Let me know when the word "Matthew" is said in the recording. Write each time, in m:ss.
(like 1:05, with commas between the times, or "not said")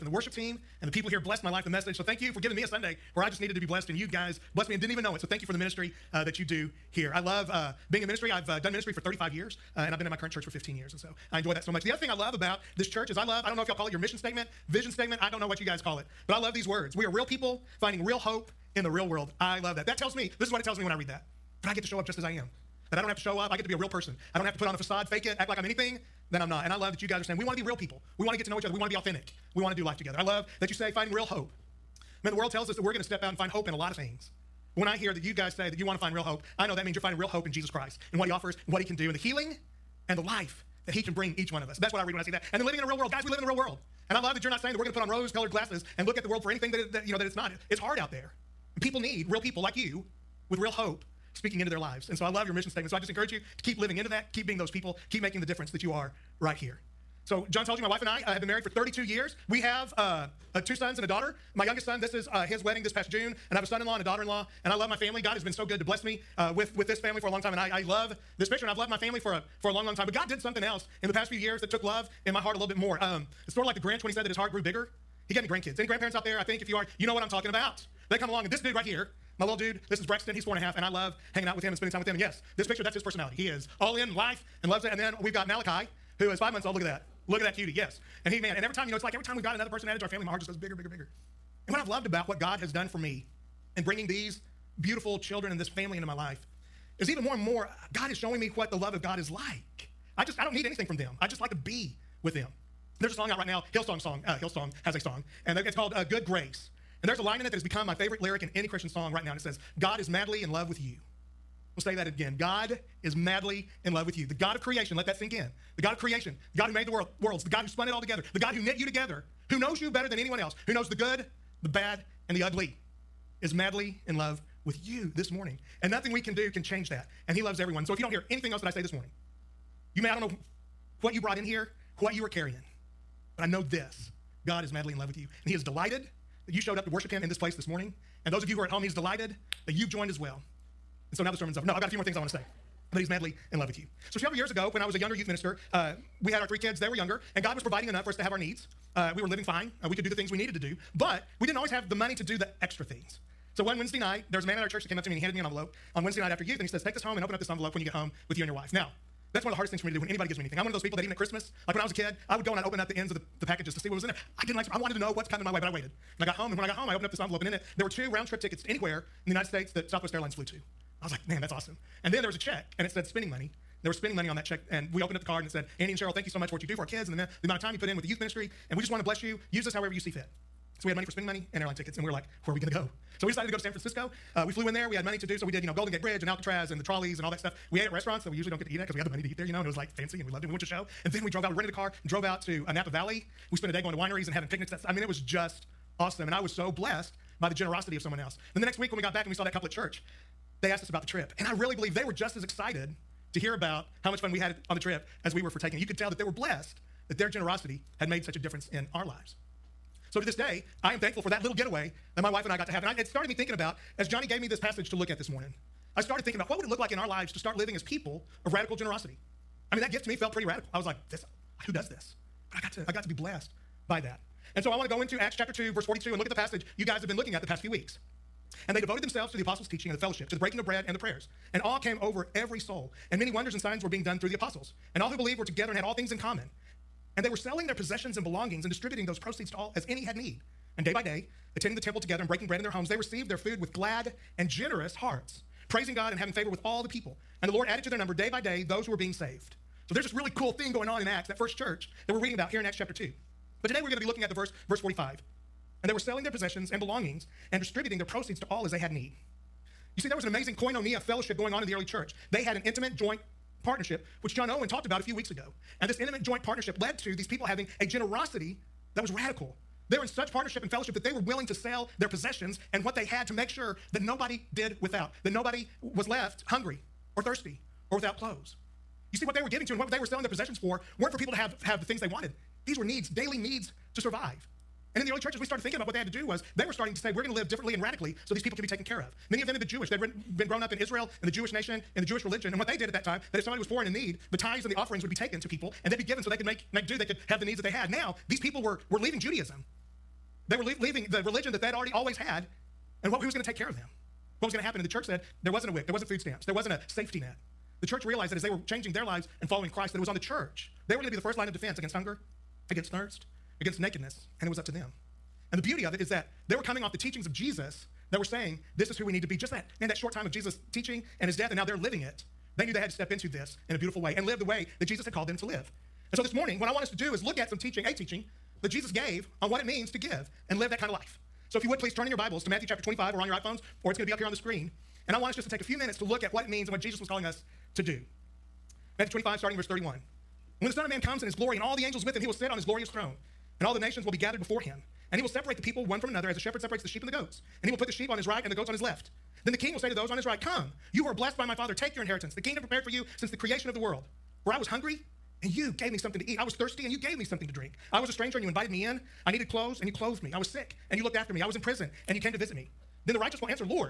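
5:32, 5:38.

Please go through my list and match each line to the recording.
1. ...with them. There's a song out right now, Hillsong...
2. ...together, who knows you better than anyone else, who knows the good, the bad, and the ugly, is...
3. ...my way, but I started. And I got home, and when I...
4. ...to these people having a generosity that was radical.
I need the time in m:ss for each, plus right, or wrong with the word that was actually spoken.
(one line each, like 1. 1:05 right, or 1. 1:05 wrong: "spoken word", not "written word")
1. 1:42 right
2. 1:58 right
3. 2:45 wrong: "waited", not "started"
4. 4:26 right.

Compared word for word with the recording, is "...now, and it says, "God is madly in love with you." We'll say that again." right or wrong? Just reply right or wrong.
right.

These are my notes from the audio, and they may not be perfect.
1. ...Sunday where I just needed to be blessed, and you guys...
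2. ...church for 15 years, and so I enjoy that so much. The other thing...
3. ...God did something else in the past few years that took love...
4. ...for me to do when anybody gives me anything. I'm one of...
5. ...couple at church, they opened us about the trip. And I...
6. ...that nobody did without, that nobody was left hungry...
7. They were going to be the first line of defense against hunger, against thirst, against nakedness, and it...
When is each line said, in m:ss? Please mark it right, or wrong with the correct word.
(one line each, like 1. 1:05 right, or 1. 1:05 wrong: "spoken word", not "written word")
1. 0:02 right
2. 0:10 right
3. 1:10 right
4. 2:39 right
5. 3:19 wrong: "asked", not "opened"
6. 4:33 right
7. 5:10 right.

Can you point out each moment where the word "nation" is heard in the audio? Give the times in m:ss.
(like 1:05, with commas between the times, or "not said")
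4:51, 5:43.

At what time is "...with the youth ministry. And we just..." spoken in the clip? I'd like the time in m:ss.
2:57.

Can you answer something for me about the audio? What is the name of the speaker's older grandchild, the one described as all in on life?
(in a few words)
Braxton.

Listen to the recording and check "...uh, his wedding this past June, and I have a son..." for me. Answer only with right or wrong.
right.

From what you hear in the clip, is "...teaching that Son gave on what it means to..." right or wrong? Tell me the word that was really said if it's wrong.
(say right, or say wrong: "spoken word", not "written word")
wrong: "Jesus", not "Son".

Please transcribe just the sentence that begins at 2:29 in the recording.
Uh, we could do the things we needed to do, but we didn't always have the money to do the extra things.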